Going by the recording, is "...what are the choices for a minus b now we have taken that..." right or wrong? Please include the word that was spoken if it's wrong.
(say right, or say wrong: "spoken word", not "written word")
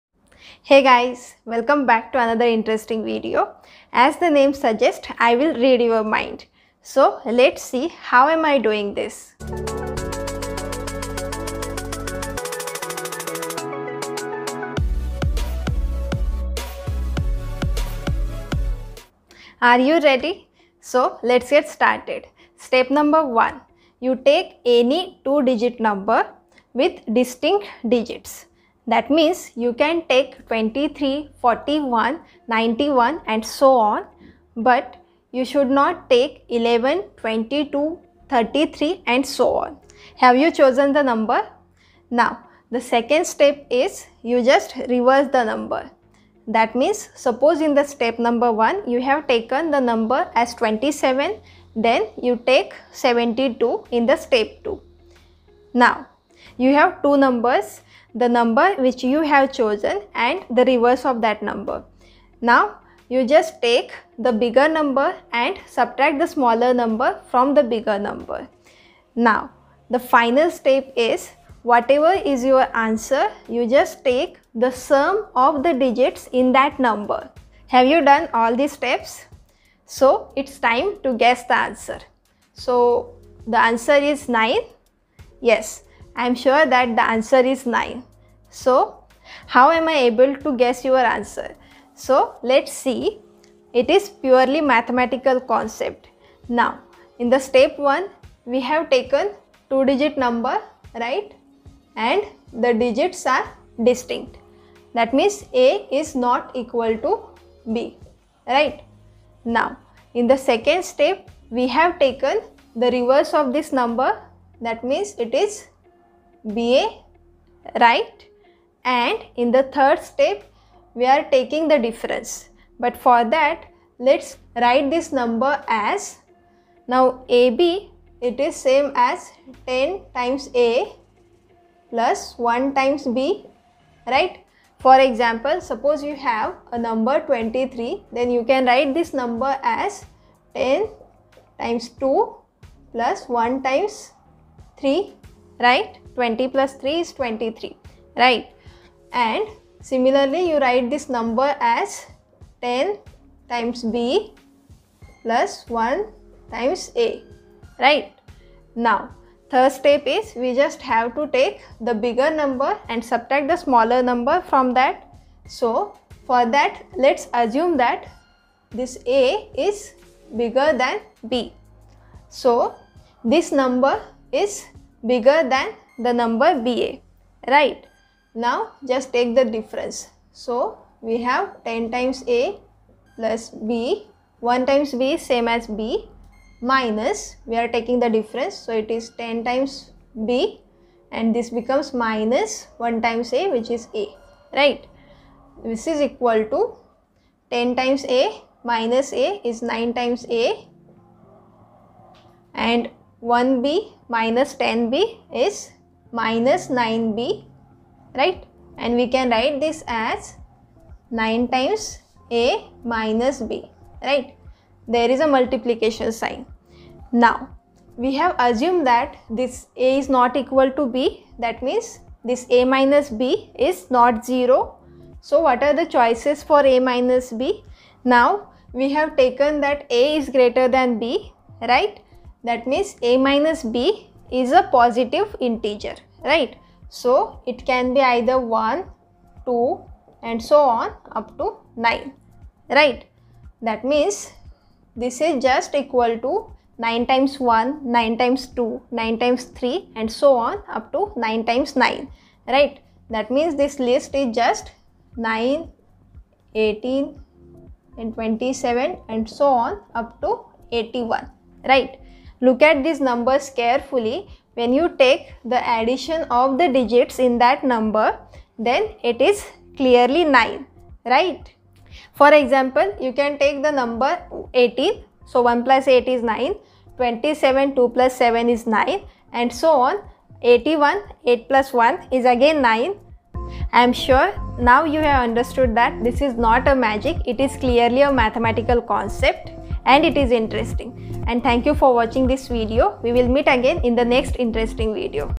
right.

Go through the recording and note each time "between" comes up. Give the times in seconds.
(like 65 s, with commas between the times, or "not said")
not said.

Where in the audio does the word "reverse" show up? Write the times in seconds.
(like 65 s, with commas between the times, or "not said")
44 s, 60 s, 112 s.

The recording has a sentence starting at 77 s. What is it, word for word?
Have you done all these steps?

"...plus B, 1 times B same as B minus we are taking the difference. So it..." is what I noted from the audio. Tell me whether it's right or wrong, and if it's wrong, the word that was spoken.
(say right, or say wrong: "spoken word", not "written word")
right.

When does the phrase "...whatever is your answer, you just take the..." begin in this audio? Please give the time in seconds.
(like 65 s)
71 s.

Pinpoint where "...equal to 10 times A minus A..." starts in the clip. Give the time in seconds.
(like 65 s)
196 s.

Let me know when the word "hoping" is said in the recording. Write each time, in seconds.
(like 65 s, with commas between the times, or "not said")
not said.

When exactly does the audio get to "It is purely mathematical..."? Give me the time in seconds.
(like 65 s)
93 s.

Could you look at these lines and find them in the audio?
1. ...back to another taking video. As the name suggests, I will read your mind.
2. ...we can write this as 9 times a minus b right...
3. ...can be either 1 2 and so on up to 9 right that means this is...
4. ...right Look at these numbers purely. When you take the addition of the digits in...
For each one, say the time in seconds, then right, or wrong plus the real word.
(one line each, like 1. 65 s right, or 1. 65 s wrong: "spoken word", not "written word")
1. 1 s wrong: "interesting", not "taking"
2. 208 s right
3. 237 s right
4. 261 s wrong: "carefully", not "purely".